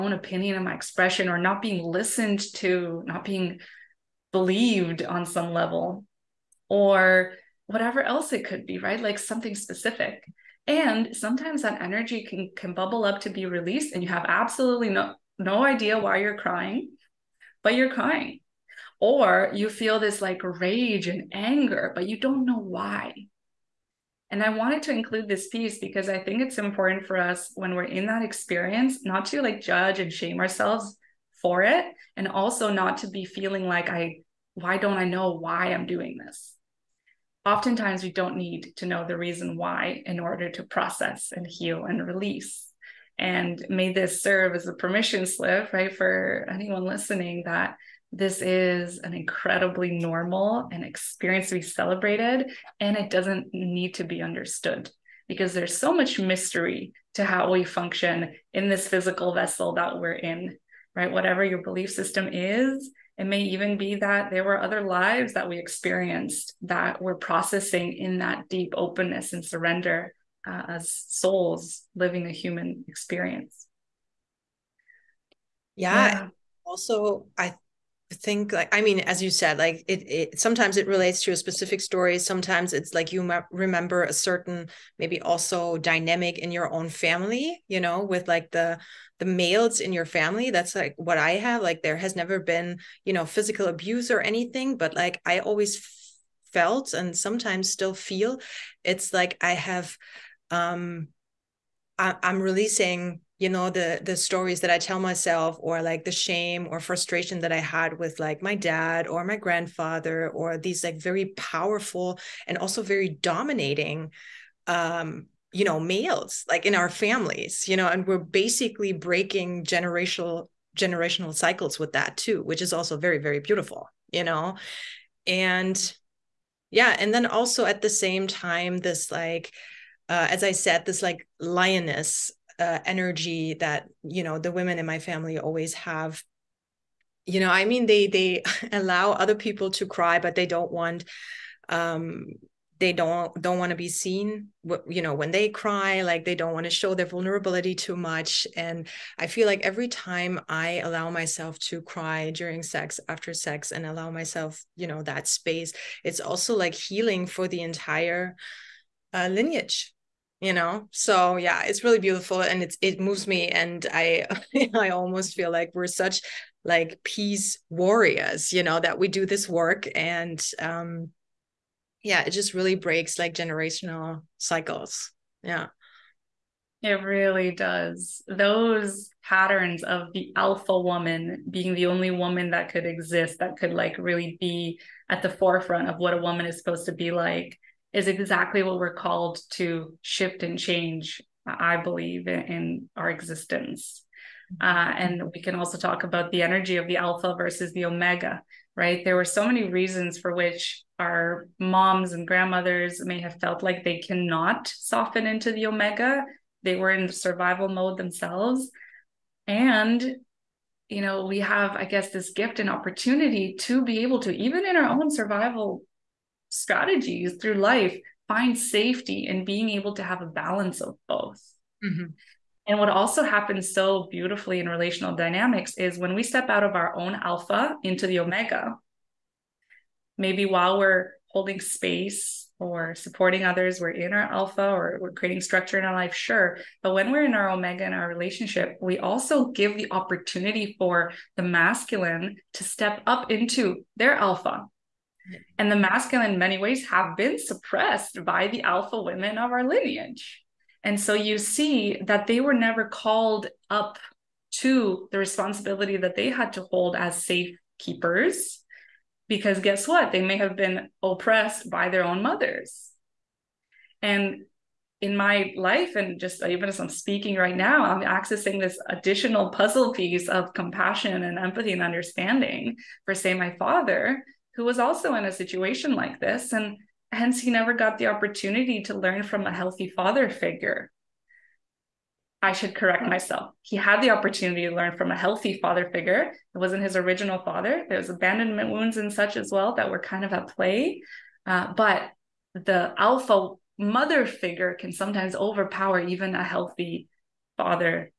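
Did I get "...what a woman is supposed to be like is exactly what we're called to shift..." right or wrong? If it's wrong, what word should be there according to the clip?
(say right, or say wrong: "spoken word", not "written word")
right.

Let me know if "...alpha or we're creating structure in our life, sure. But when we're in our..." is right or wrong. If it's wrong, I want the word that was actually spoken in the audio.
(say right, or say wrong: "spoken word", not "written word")
right.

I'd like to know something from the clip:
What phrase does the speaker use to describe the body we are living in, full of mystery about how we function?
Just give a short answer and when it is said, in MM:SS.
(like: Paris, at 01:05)
physical vessel, at 00:58.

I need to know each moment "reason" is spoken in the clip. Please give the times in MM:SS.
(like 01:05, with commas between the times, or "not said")
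00:39, 03:19.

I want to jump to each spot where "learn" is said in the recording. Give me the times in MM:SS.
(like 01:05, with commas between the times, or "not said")
04:38, 04:44.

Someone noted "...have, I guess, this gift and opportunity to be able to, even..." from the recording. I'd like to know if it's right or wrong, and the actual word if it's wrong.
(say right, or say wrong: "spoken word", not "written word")
right.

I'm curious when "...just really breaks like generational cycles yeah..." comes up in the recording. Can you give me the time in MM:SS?
02:52.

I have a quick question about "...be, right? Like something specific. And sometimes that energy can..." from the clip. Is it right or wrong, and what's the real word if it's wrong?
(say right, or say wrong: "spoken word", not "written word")
right.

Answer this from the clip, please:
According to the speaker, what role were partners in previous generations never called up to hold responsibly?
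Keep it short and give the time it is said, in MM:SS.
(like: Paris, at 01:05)
safe keepers, at 04:17.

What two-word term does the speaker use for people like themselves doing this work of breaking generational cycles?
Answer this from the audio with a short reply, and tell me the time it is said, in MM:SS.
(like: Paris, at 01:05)
peace warriors, at 02:47.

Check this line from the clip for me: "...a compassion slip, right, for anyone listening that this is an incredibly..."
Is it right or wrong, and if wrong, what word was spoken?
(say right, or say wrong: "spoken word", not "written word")
wrong: "permission", not "compassion".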